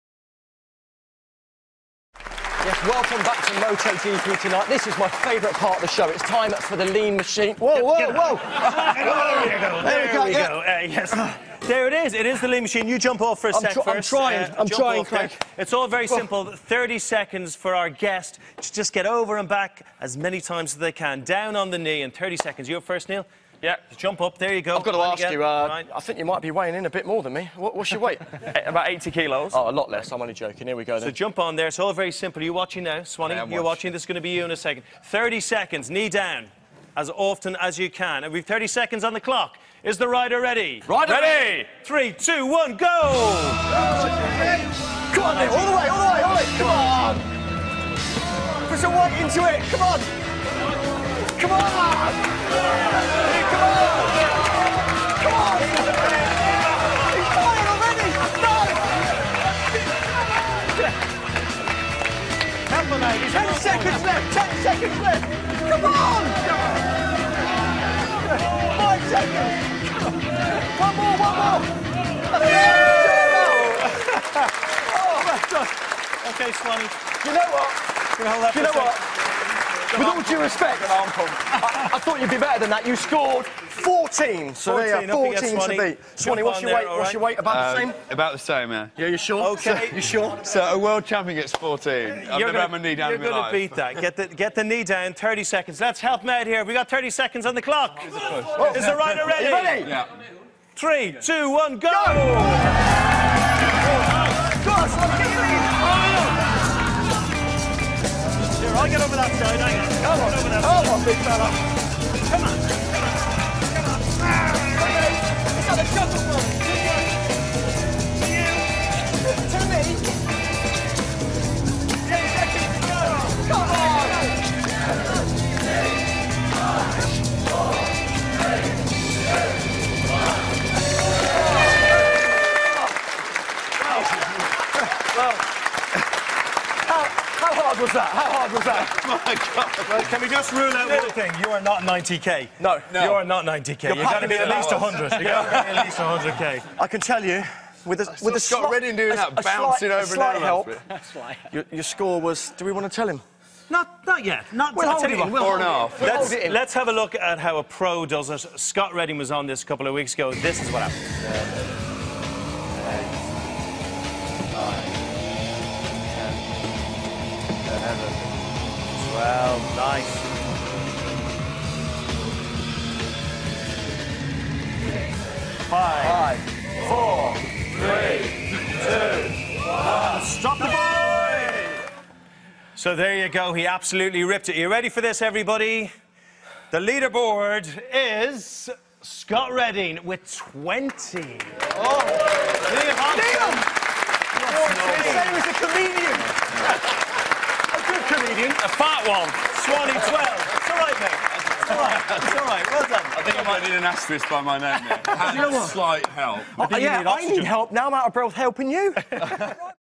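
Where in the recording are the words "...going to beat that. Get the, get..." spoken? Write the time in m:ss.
1:33.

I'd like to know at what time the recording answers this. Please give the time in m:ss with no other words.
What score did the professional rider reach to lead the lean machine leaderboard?
3:09.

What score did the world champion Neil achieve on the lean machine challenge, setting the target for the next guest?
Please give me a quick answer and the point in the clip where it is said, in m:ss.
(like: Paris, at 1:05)
14, at 1:22.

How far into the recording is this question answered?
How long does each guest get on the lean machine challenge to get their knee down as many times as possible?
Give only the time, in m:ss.
0:16.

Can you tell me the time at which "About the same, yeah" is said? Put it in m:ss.
1:28.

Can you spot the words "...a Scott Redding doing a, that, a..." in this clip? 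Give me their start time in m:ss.
2:28.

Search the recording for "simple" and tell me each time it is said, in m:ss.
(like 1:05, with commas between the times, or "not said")
0:16, 0:32.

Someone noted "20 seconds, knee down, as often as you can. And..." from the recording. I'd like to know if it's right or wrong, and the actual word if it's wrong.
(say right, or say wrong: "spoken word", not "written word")
wrong: "30", not "20".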